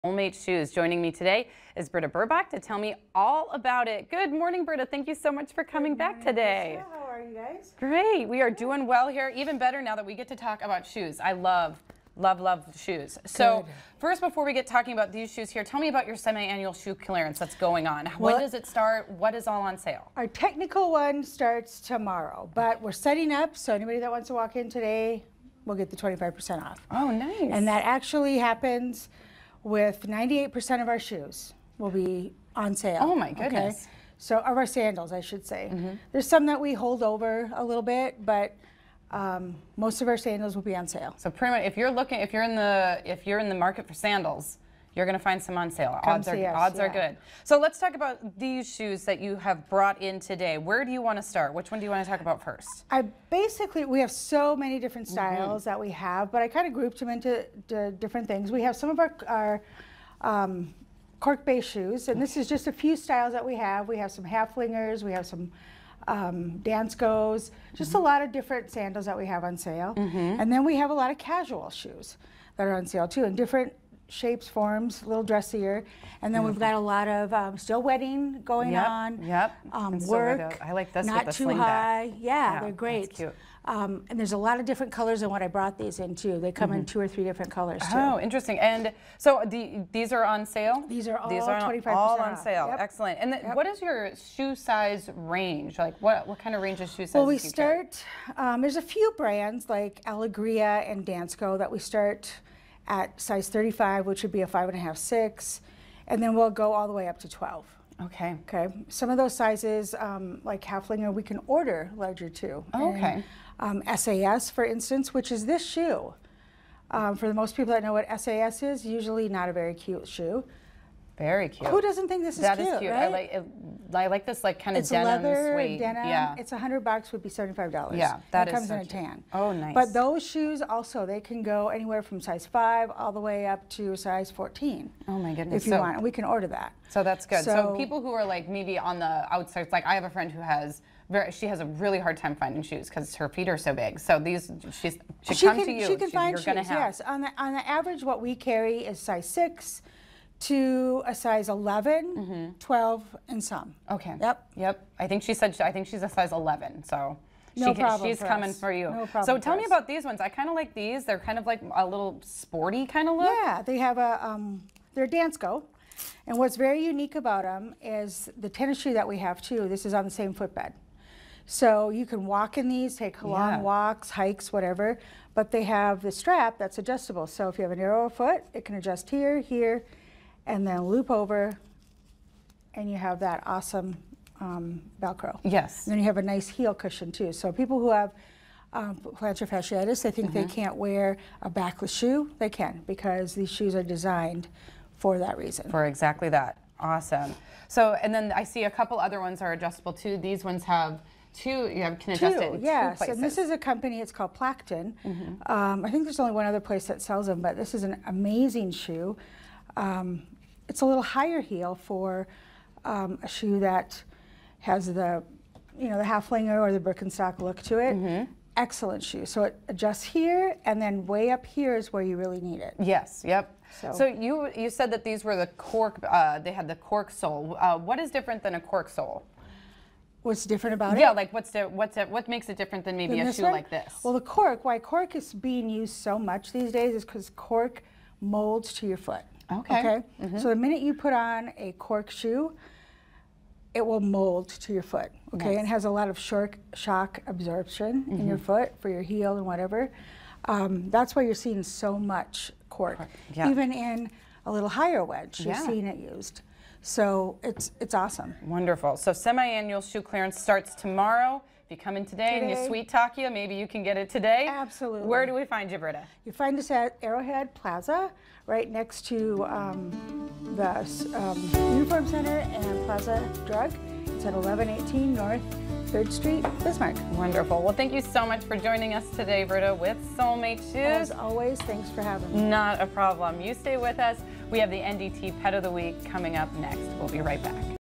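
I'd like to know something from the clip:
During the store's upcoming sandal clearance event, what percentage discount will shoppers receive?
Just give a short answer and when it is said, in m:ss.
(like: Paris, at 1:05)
25%, at 0:25.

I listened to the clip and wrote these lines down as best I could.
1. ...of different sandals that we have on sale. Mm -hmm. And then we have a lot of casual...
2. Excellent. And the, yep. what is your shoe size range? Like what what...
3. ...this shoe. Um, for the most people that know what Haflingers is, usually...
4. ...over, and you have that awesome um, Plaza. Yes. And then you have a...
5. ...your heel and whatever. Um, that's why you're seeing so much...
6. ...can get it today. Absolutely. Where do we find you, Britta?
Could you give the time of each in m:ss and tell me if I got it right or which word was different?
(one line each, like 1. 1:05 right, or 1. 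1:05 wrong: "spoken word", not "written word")
1. 1:08 right
2. 1:32 right
3. 1:55 wrong: "SAS", not "Haflingers"
4. 3:01 wrong: "Velcro", not "Plaza"
5. 4:08 right
6. 4:23 right.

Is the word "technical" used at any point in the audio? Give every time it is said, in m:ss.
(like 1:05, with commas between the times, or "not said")
0:20.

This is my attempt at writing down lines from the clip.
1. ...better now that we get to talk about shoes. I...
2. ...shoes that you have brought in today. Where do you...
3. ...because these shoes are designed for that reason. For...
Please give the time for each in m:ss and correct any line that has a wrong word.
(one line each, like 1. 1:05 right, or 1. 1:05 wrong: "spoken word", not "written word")
1. 0:09 right
2. 0:48 right
3. 3:12 right.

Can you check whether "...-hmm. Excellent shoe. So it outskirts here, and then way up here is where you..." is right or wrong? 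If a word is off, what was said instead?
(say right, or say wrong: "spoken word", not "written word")
wrong: "adjusts", not "outskirts".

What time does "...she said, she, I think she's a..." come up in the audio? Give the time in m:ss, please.
2:35.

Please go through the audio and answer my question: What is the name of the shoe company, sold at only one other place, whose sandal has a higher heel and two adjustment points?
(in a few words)
Plakton.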